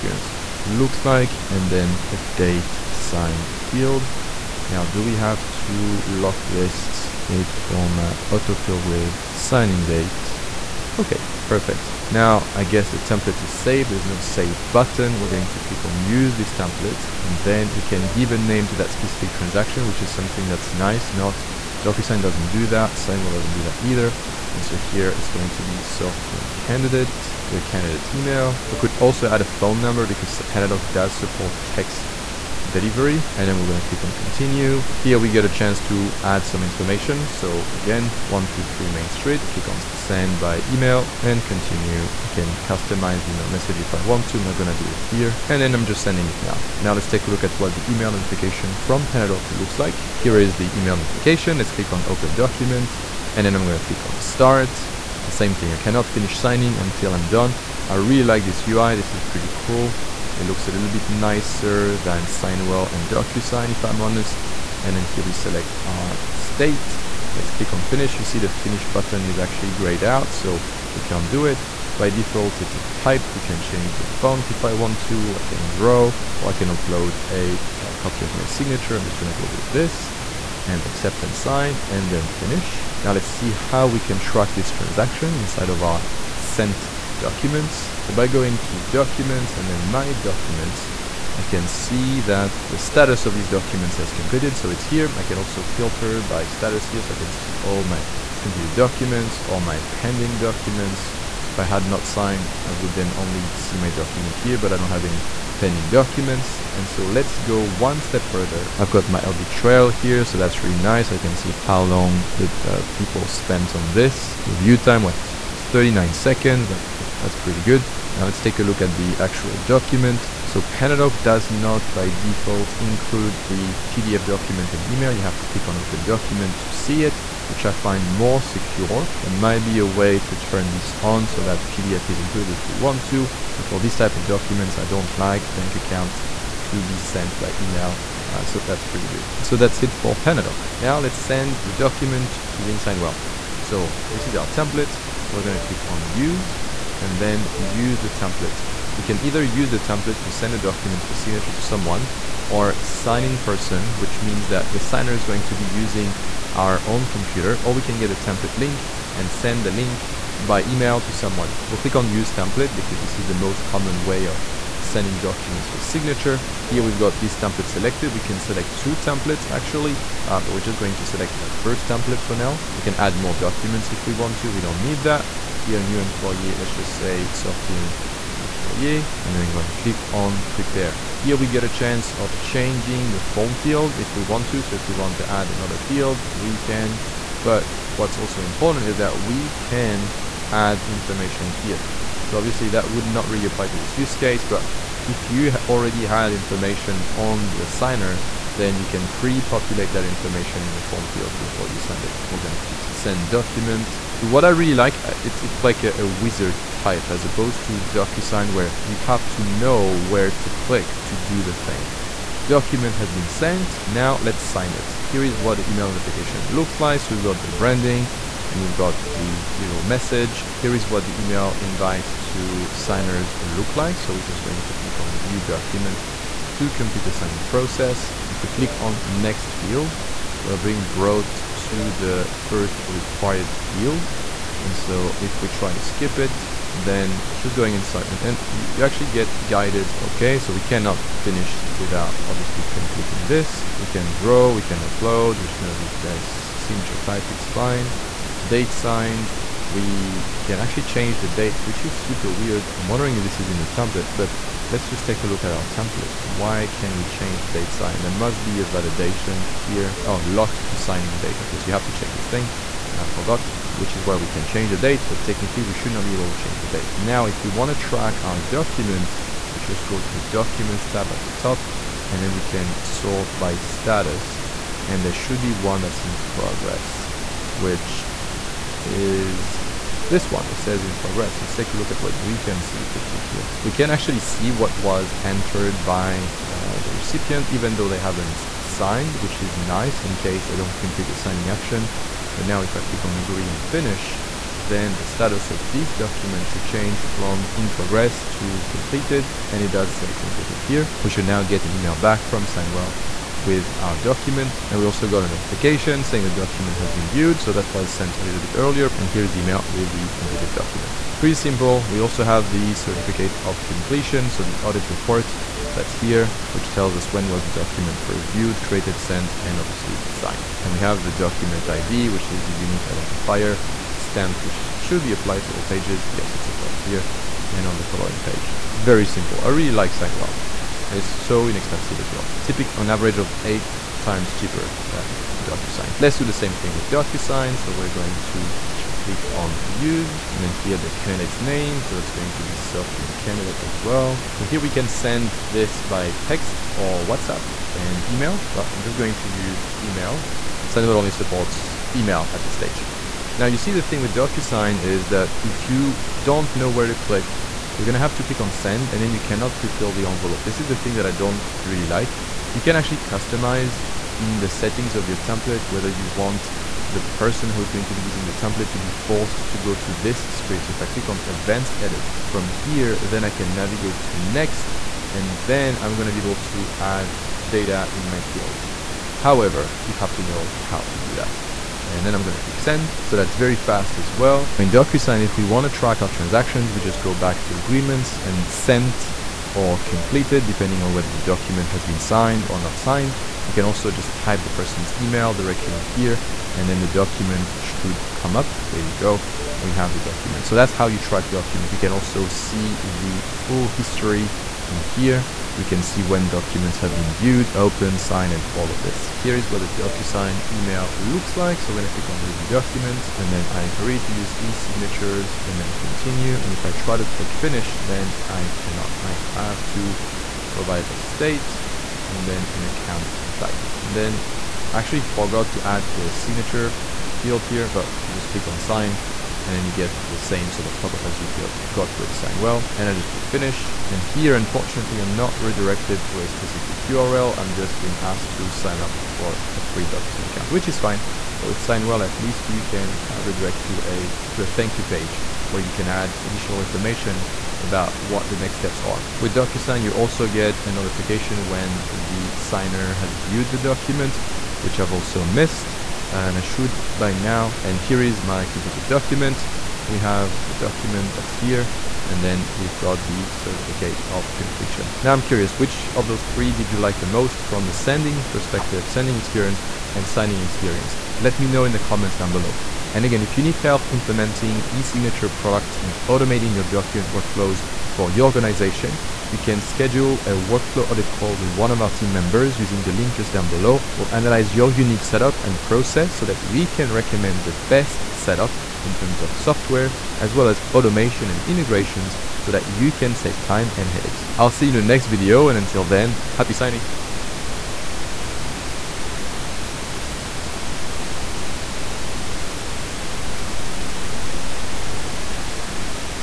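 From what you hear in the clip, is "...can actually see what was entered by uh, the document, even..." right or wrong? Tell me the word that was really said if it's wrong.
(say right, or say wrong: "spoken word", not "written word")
wrong: "recipient", not "document".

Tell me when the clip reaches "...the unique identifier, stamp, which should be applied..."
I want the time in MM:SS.
05:22.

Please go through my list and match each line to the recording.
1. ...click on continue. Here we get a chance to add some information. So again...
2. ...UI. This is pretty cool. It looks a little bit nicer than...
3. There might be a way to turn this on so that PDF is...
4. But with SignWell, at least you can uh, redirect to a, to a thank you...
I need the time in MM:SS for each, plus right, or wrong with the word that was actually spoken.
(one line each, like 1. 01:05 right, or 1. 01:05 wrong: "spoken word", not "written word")
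1. 00:33 right
2. 00:58 right
3. 02:09 right
4. 07:21 right.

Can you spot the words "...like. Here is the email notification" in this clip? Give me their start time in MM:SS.
00:49.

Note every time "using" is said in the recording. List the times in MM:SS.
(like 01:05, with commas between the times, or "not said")
02:22, 02:35, 06:08, 08:02.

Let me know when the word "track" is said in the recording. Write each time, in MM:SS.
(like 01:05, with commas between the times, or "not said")
01:24, 04:27, 06:25, 06:40.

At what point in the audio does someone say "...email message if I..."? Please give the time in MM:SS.
00:43.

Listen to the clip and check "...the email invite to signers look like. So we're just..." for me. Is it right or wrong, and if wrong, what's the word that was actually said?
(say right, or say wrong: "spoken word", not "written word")
right.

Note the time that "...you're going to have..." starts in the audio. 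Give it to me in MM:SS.
05:57.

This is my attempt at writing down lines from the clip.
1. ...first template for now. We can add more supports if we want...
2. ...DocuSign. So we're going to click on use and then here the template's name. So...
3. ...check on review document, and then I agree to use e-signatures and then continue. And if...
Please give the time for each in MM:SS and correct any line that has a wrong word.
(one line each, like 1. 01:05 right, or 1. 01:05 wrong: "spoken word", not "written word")
1. 02:51 wrong: "documents", not "supports"
2. 05:36 wrong: "candidate", not "template"
3. 06:51 wrong: "click", not "check".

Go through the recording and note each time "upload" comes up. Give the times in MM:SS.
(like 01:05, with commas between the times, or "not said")
01:16, 04:04.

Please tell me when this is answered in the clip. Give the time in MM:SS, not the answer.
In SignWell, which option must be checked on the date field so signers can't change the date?
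04:20.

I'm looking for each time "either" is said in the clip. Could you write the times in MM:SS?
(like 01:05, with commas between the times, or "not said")
00:23, 02:29.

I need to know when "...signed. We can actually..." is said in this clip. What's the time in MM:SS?
04:08.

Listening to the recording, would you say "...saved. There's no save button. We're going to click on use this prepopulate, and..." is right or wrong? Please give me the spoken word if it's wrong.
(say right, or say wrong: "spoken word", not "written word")
wrong: "template", not "prepopulate".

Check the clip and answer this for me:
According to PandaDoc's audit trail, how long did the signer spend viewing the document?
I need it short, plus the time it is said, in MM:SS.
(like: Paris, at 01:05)
39 seconds, at 01:55.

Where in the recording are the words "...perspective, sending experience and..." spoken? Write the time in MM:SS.
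07:48.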